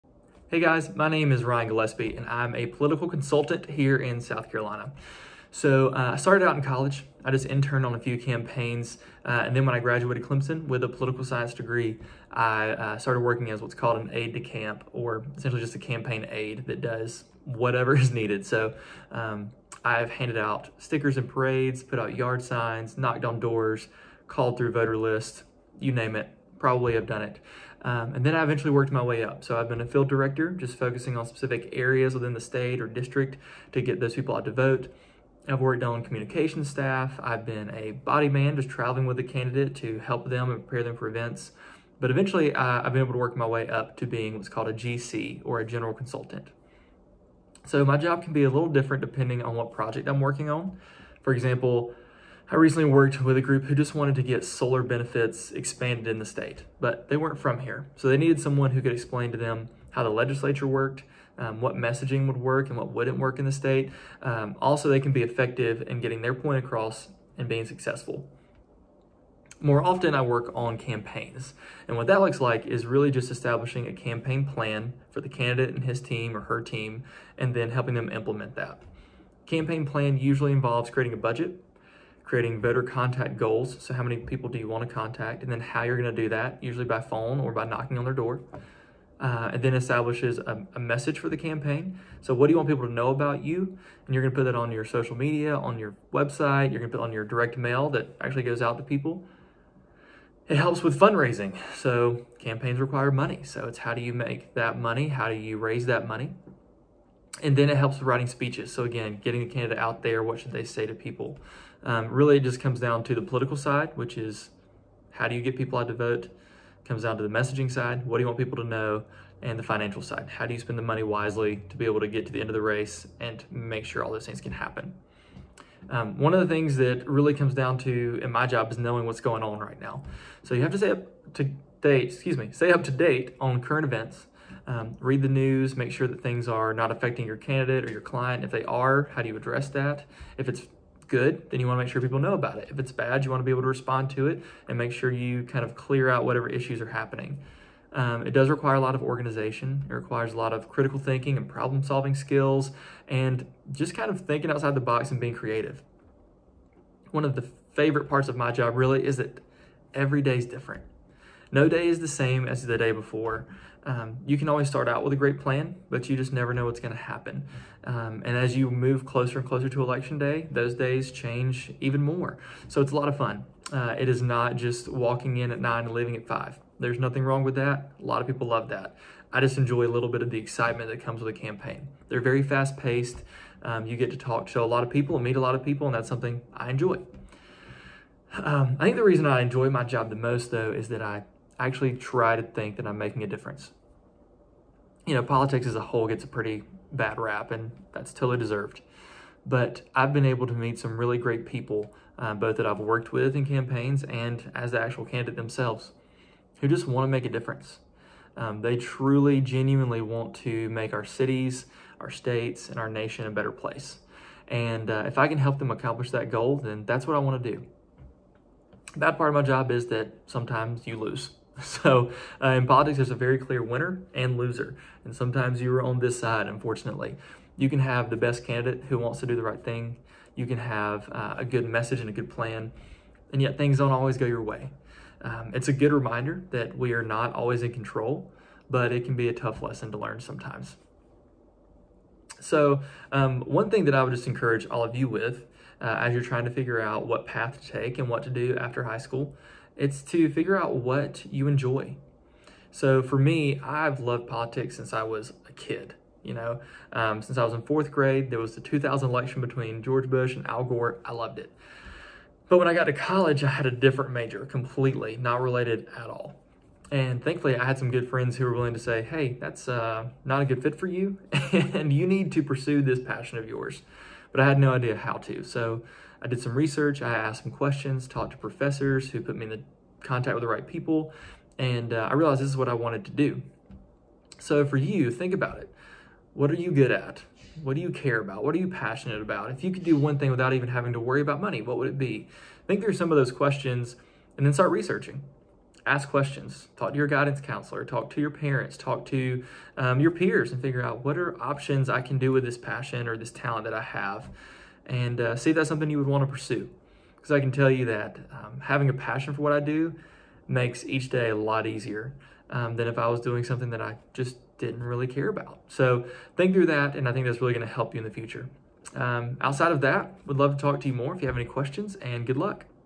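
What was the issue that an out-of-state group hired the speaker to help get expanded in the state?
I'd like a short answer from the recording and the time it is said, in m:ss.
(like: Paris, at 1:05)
Solar benefits, at 0:54.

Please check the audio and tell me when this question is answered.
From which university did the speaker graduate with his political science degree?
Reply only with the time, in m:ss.
0:10.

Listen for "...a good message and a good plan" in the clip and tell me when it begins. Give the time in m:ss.
3:51.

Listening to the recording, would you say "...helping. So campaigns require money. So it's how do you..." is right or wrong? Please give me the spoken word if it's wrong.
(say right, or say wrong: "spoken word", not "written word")
wrong: "fundraising", not "helping".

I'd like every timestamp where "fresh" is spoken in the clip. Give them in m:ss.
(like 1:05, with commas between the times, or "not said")
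not said.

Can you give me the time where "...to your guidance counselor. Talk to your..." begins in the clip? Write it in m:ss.
4:56.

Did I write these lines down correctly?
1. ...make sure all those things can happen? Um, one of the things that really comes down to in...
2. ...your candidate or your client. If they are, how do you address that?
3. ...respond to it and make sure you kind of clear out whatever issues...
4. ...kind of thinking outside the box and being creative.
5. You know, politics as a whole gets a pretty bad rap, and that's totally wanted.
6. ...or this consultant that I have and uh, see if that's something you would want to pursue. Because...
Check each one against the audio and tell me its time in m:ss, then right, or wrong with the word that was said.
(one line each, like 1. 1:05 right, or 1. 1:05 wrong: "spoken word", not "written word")
1. 2:03 right
2. 2:17 right
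3. 2:23 right
4. 2:33 right
5. 3:15 wrong: "deserved", not "wanted"
6. 5:03 wrong: "talent", not "consultant".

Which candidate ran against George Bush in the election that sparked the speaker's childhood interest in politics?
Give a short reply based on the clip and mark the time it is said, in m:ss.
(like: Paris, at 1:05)
Al Gore, at 4:20.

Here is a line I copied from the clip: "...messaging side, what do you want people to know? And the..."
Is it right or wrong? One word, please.
right.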